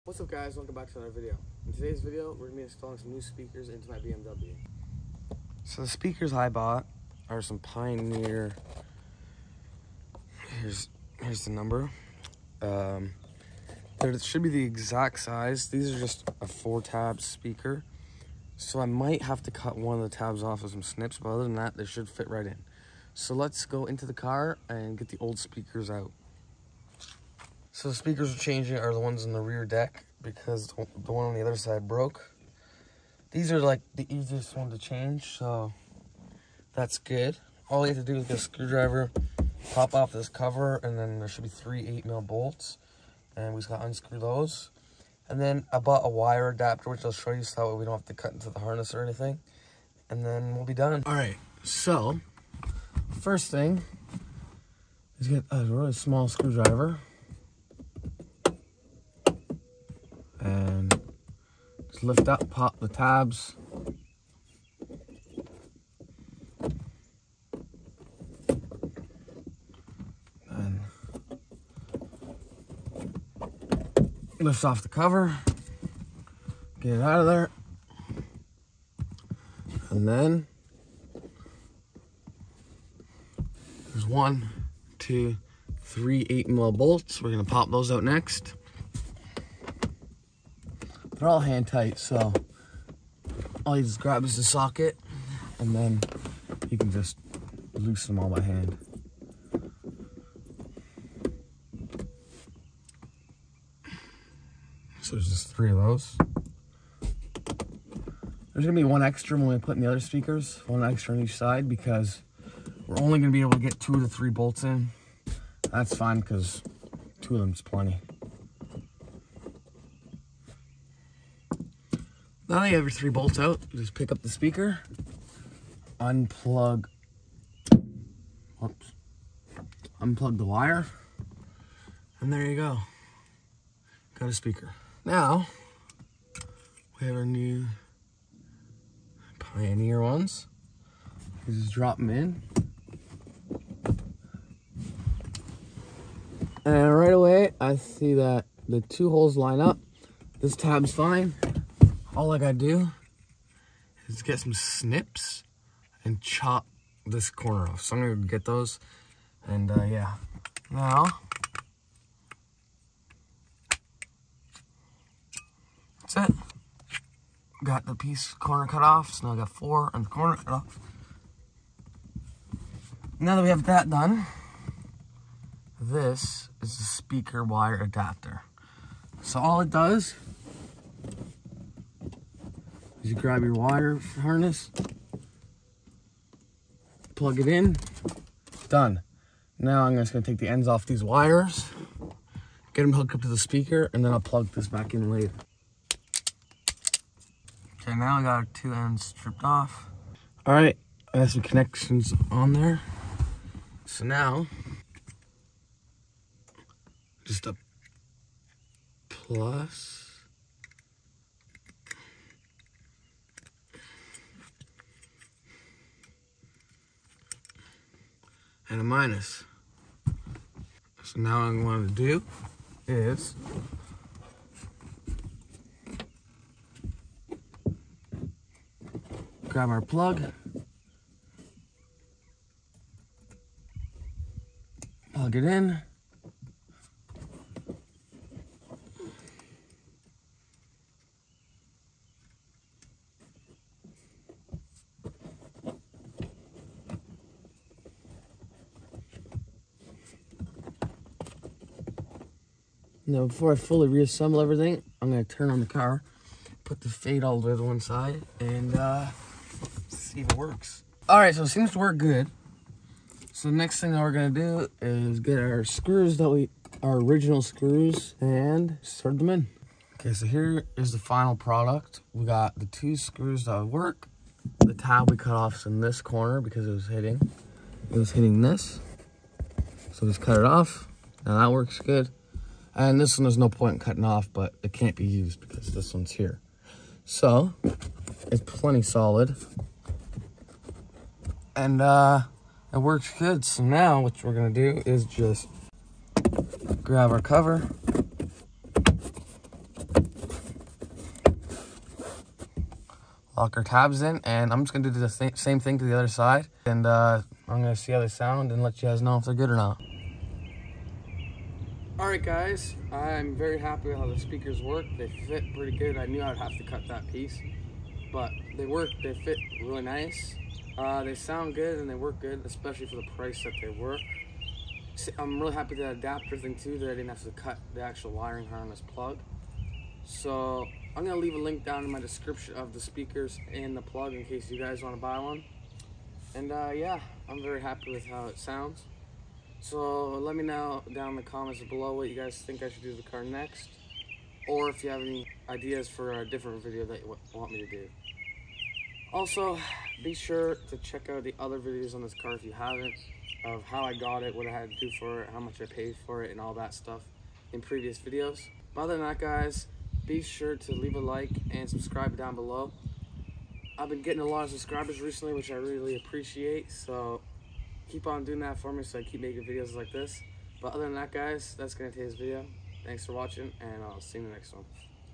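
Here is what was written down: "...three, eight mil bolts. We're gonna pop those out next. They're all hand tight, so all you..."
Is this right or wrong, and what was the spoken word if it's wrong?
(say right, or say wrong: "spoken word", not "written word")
right.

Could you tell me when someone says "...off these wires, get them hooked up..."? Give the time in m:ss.
3:10.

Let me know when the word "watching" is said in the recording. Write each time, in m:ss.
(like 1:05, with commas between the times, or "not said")
6:13.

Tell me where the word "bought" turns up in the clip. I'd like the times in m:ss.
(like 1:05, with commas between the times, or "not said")
0:06, 0:45.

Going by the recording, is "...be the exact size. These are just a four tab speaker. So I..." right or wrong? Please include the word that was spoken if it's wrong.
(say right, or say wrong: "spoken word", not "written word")
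right.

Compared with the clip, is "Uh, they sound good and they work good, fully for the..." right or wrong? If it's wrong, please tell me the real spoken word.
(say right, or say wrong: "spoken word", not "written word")
wrong: "especially", not "fully".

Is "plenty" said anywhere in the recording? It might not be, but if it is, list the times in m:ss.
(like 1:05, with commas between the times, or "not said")
1:57, 4:48.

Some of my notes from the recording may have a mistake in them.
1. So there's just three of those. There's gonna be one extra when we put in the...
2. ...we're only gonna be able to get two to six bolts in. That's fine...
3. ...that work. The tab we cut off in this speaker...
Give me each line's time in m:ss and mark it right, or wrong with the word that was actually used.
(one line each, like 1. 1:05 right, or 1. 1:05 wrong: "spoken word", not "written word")
1. 1:45 right
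2. 1:52 wrong: "three", not "six"
3. 4:33 wrong: "corner", not "speaker".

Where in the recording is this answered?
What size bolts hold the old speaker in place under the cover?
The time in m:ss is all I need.
0:41.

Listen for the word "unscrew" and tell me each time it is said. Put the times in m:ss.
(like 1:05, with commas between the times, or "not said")
0:43.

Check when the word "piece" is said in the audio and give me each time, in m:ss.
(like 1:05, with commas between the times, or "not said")
2:47, 5:17.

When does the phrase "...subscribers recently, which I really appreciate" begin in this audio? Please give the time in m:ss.
6:04.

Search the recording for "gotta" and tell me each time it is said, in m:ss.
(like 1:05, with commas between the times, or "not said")
0:43, 2:32.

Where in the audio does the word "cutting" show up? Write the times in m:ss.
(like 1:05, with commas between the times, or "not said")
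4:43.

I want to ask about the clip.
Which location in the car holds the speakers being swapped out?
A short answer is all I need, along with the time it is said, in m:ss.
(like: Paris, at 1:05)
rear deck, at 0:29.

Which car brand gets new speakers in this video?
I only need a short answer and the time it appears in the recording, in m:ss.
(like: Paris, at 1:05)
BMW, at 0:03.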